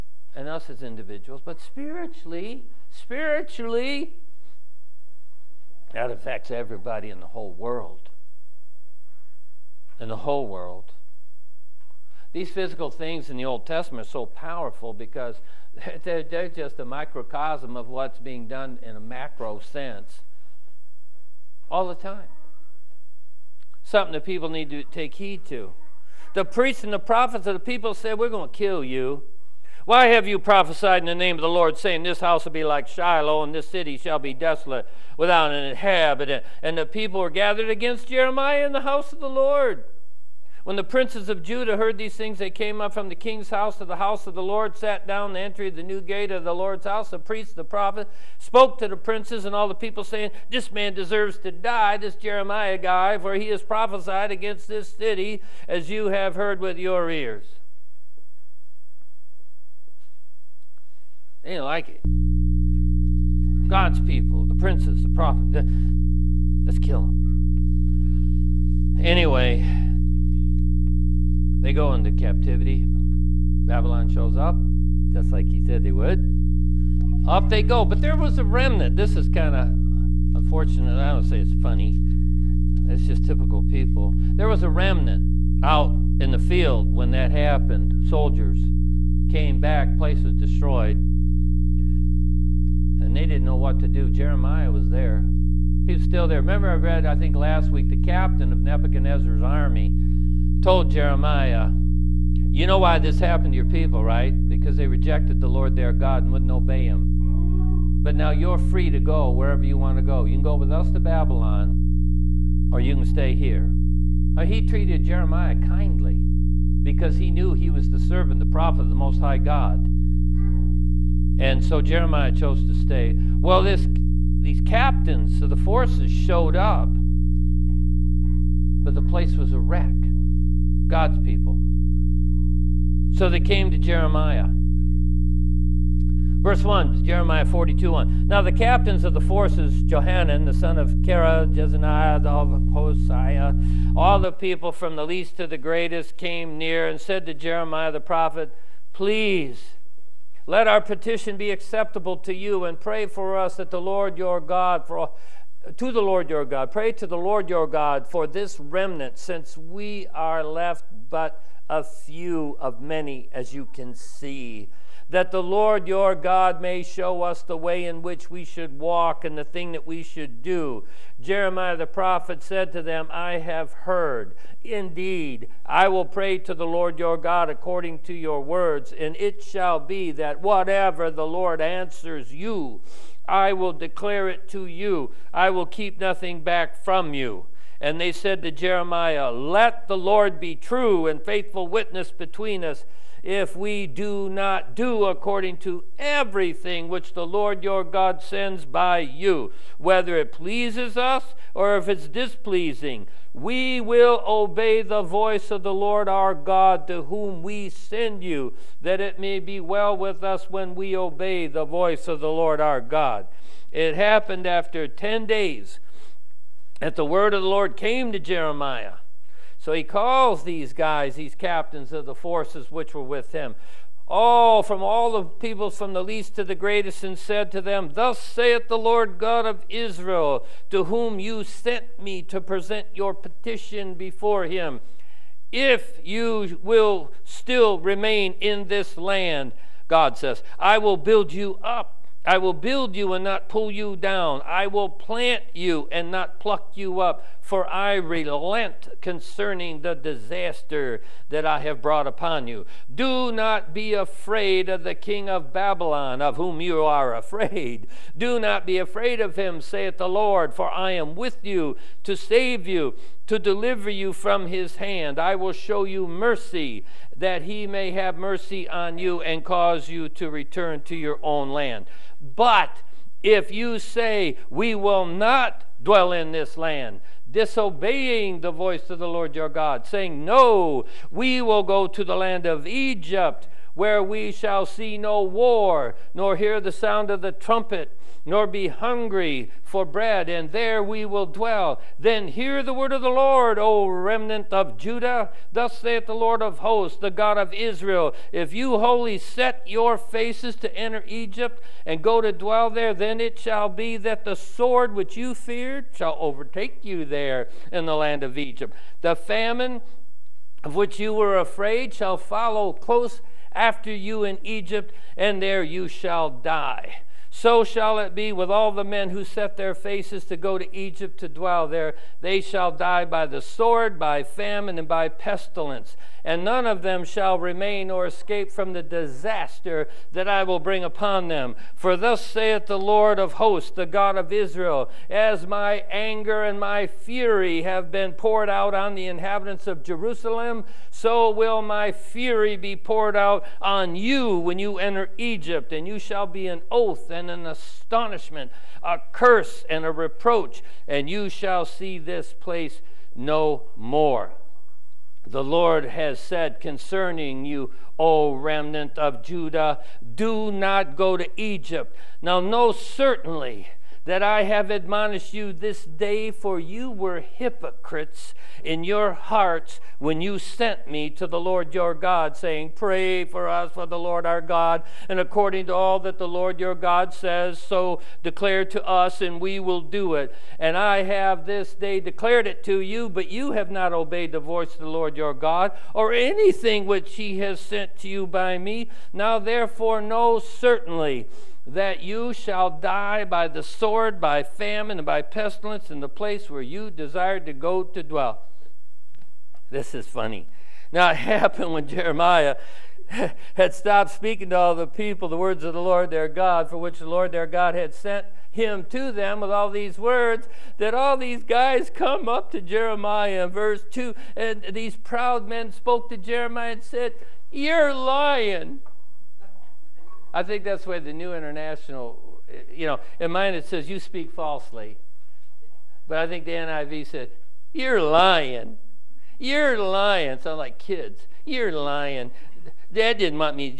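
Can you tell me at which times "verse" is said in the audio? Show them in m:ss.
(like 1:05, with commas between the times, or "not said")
2:16, 6:53.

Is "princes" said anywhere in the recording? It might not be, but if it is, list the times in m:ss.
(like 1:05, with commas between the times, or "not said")
0:40, 0:48, 1:04.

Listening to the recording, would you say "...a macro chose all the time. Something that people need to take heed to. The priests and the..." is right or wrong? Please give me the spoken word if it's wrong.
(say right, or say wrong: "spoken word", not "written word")
wrong: "sense", not "chose".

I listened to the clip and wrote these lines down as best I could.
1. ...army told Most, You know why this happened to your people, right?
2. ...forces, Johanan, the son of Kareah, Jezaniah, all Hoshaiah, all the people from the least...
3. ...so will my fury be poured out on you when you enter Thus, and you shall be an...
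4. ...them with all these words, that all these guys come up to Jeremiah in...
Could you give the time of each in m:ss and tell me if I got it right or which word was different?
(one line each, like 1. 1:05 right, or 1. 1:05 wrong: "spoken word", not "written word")
1. 1:39 wrong: "Jeremiah", not "Most"
2. 2:19 right
3. 5:40 wrong: "Egypt", not "Thus"
4. 6:49 right.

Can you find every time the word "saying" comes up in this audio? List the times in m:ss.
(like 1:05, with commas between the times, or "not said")
0:31, 0:50, 4:39, 6:12.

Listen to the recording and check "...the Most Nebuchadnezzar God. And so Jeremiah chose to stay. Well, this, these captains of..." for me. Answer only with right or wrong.
wrong.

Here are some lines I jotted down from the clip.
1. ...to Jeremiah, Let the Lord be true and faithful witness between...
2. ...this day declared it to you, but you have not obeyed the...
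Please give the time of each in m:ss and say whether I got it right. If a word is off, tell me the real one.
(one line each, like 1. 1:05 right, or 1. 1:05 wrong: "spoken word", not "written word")
1. 3:08 right
2. 6:21 right.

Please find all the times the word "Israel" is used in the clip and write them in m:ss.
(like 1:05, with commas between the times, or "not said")
3:49, 4:57, 5:34.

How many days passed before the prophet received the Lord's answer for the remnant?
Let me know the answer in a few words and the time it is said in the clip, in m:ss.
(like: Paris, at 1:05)
10, at 3:34.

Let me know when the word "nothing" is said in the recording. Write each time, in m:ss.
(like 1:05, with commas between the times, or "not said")
3:05.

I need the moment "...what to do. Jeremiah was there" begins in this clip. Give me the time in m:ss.
1:33.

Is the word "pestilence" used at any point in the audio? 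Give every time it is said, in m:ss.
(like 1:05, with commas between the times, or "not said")
5:25, 6:35.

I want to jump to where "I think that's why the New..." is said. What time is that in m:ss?
7:00.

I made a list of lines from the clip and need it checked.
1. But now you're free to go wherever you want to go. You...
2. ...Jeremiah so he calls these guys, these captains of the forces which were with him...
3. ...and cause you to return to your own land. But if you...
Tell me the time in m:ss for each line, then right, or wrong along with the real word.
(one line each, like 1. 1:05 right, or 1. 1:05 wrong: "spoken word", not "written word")
1. 1:48 right
2. 3:38 right
3. 4:29 right.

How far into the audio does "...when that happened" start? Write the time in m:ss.
1:26.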